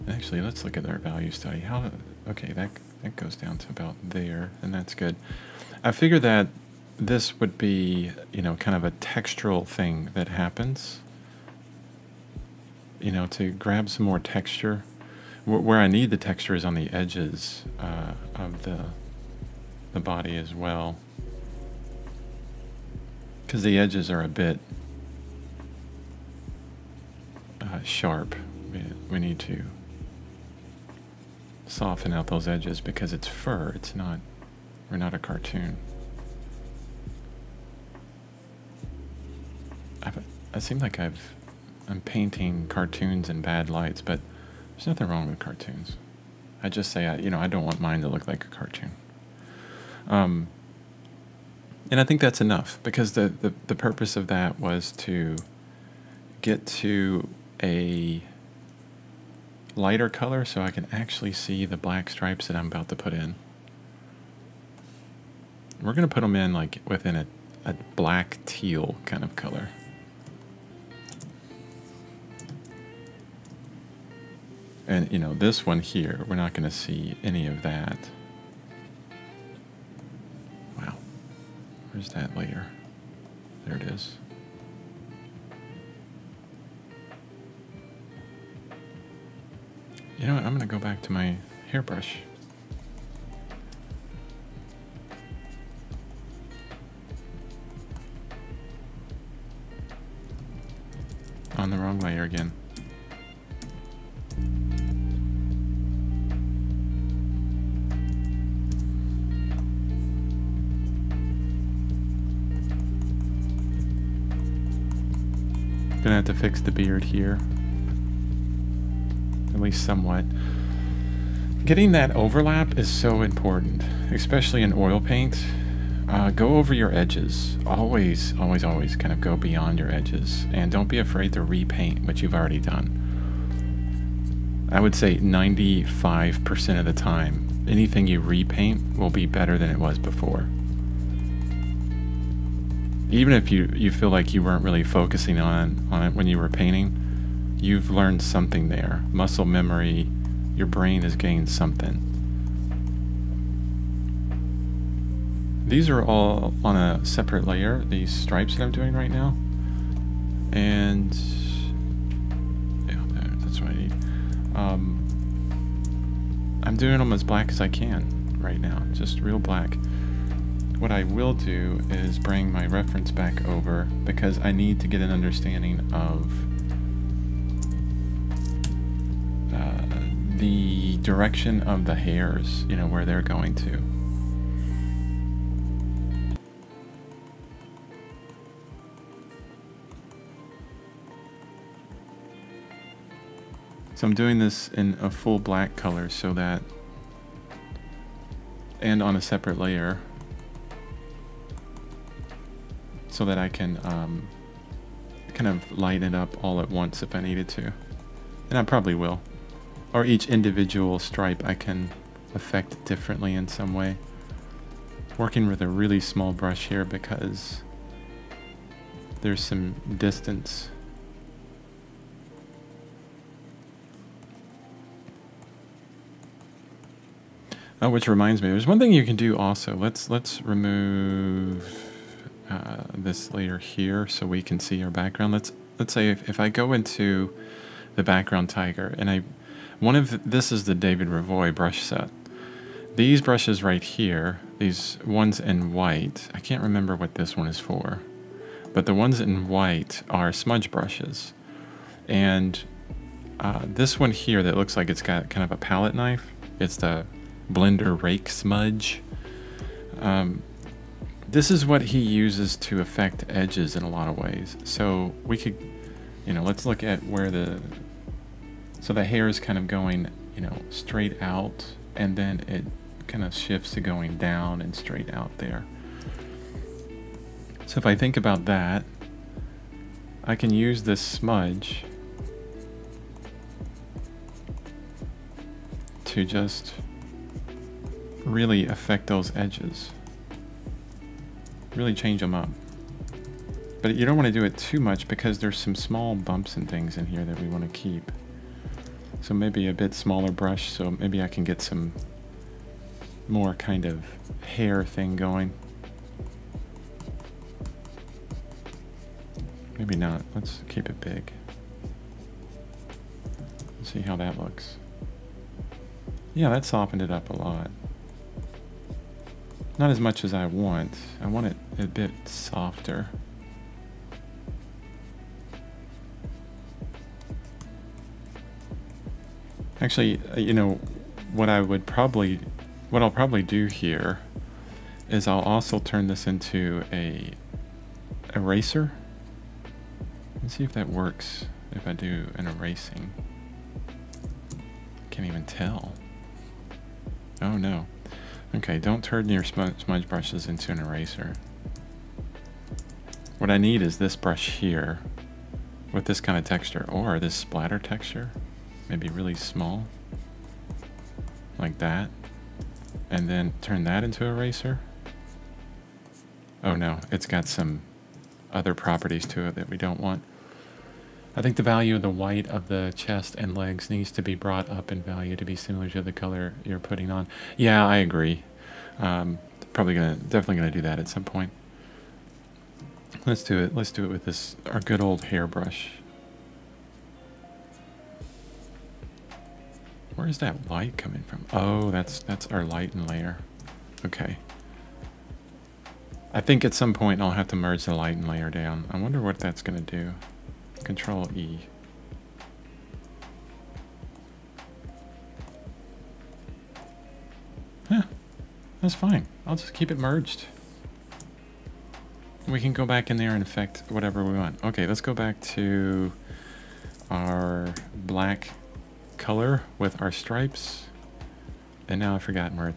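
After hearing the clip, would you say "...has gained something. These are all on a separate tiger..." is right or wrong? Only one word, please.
wrong.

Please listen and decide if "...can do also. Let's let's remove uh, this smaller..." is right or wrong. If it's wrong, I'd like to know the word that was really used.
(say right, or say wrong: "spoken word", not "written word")
wrong: "layer", not "smaller".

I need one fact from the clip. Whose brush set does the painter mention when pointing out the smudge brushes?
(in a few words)
David Revoy.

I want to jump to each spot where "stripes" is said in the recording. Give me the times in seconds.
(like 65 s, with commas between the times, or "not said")
62 s, 158 s, 210 s, 420 s.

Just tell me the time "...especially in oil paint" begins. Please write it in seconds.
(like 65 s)
124 s.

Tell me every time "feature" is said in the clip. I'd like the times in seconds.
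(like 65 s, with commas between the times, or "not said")
not said.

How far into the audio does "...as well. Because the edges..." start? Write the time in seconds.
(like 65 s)
20 s.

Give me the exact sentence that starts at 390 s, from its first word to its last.
Where is that light coming from?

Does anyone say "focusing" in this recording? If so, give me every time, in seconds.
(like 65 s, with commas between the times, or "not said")
144 s.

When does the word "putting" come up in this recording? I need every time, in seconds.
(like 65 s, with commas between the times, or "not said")
376 s.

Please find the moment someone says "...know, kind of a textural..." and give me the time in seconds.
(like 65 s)
8 s.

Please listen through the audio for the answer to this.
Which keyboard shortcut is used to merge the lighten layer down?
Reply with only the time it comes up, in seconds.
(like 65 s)
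400 s.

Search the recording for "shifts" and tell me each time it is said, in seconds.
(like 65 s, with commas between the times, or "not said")
273 s.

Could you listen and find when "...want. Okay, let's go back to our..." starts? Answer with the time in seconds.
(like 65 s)
414 s.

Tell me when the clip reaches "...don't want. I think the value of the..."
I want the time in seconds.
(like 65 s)
369 s.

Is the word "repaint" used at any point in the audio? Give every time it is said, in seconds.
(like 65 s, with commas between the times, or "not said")
131 s, 138 s.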